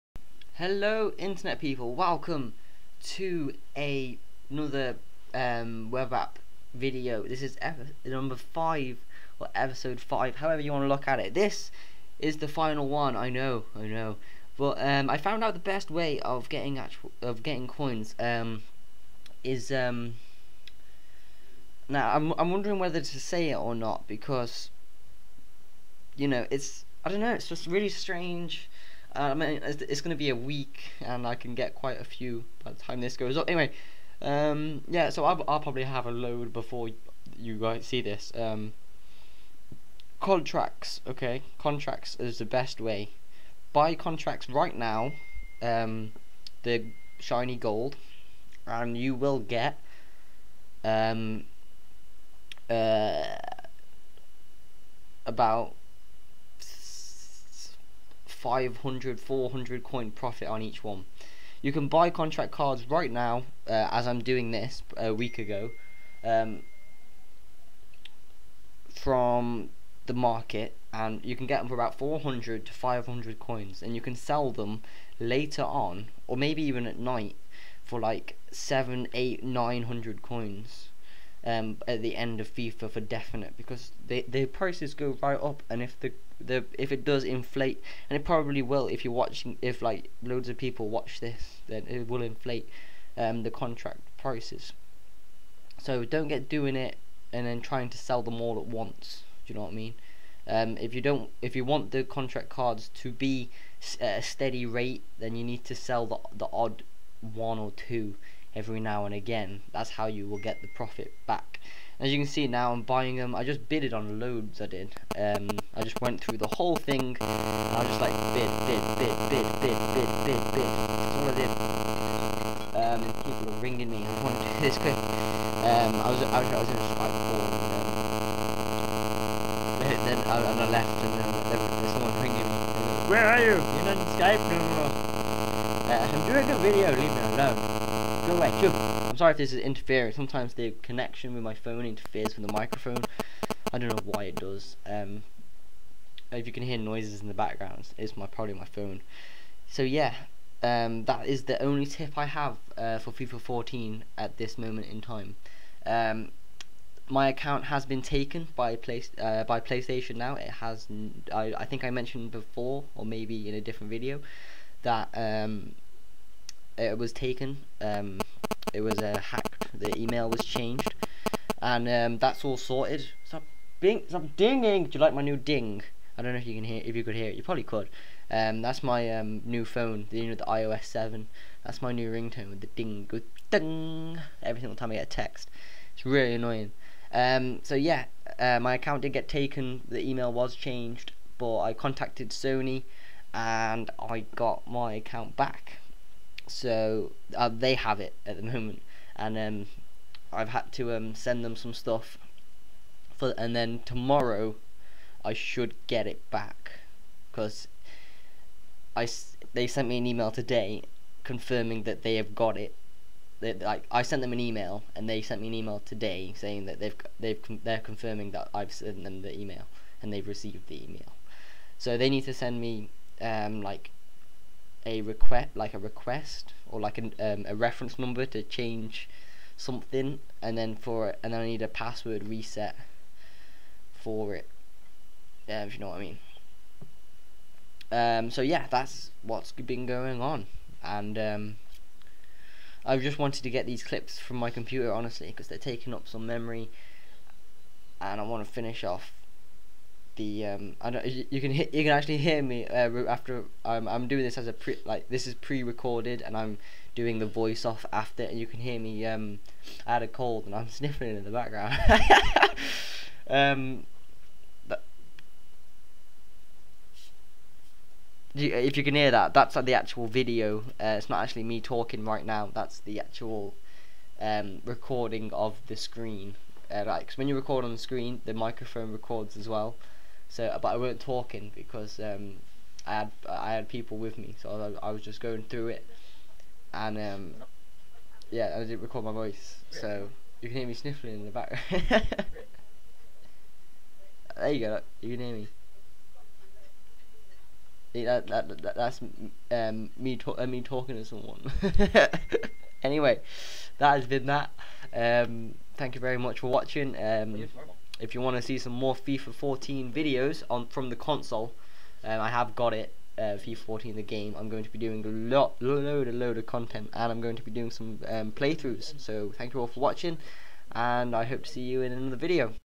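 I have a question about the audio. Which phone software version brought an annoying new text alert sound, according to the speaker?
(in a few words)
iOS 7.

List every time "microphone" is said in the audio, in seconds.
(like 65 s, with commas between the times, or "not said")
142 s, 278 s.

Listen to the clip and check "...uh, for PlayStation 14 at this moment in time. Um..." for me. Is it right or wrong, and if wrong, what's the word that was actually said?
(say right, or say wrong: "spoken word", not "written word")
wrong: "FIFA", not "PlayStation".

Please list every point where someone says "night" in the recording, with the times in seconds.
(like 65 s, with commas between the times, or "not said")
76 s.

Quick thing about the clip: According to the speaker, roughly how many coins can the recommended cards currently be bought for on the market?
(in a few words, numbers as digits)
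400 to 500.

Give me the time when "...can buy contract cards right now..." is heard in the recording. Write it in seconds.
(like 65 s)
61 s.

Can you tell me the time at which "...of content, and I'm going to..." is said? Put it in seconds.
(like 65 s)
316 s.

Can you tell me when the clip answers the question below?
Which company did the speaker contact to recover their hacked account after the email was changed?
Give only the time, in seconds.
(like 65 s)
192 s.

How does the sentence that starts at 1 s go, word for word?
Welcome to a, another um, web app video.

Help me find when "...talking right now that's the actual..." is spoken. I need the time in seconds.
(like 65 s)
271 s.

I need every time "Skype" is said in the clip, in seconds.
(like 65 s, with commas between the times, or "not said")
126 s, 134 s.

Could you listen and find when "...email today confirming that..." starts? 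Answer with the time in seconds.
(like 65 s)
210 s.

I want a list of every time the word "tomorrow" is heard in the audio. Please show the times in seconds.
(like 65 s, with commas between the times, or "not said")
203 s.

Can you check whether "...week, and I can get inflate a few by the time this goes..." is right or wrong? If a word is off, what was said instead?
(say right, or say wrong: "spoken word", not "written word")
wrong: "quite", not "inflate".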